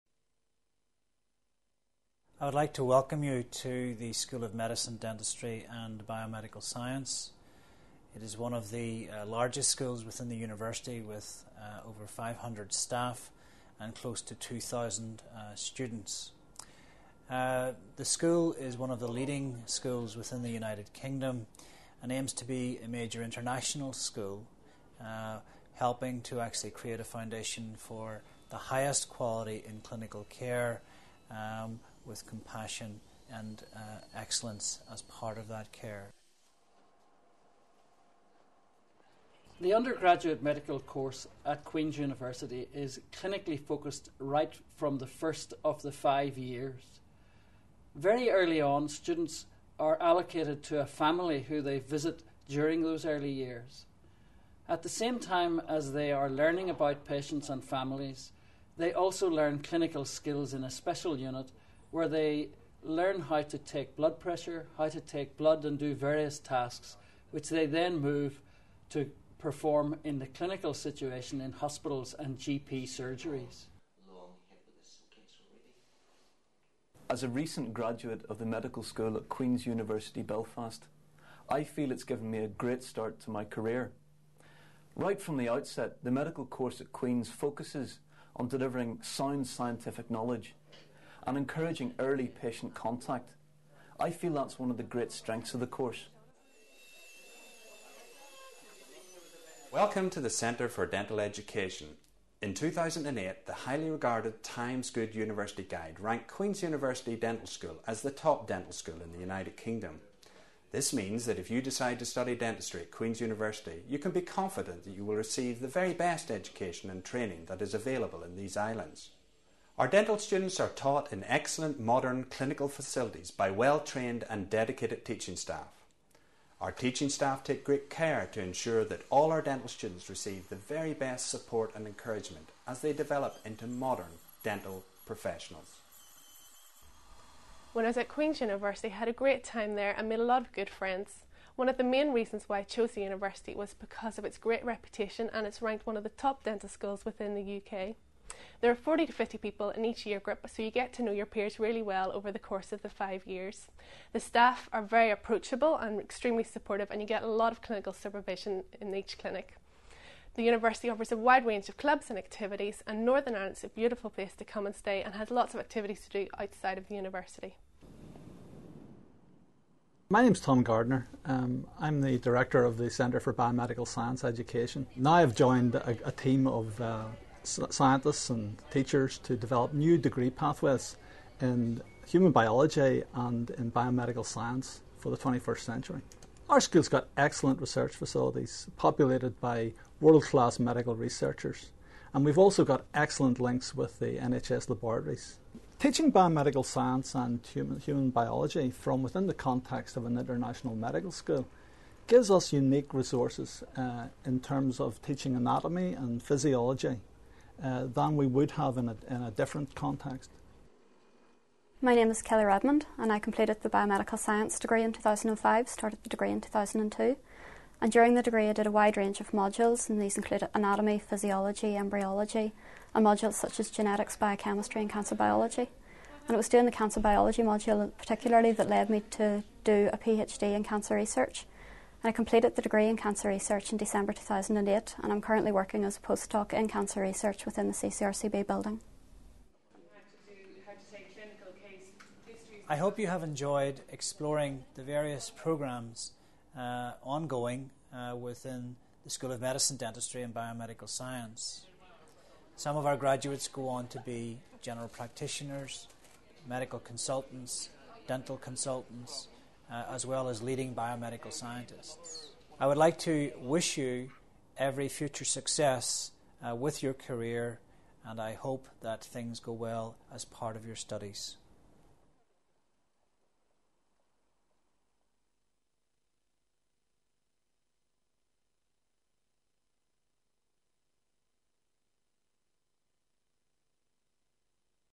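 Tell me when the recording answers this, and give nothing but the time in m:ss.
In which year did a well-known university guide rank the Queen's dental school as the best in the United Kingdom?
1:42.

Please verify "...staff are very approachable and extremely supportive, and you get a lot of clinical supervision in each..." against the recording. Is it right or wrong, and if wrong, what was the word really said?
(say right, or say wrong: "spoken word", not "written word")
right.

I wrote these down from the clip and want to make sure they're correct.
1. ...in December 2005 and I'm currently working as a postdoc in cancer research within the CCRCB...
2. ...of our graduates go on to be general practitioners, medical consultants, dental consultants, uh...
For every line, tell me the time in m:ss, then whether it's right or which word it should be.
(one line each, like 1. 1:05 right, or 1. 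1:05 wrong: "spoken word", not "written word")
1. 3:53 wrong: "2008", not "2005"
2. 4:12 right.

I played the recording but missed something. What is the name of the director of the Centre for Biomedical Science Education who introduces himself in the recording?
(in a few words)
Tom Gardner.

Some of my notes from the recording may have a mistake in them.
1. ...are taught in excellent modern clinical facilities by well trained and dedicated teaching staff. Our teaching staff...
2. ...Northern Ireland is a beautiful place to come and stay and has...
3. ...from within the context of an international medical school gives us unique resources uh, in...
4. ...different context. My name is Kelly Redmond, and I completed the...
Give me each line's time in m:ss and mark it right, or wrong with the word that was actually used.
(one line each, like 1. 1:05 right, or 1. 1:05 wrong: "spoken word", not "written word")
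1. 2:00 right
2. 2:43 right
3. 3:18 right
4. 3:29 right.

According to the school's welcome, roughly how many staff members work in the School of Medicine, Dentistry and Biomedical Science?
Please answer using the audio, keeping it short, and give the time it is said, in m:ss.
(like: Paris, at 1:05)
over 500, at 0:11.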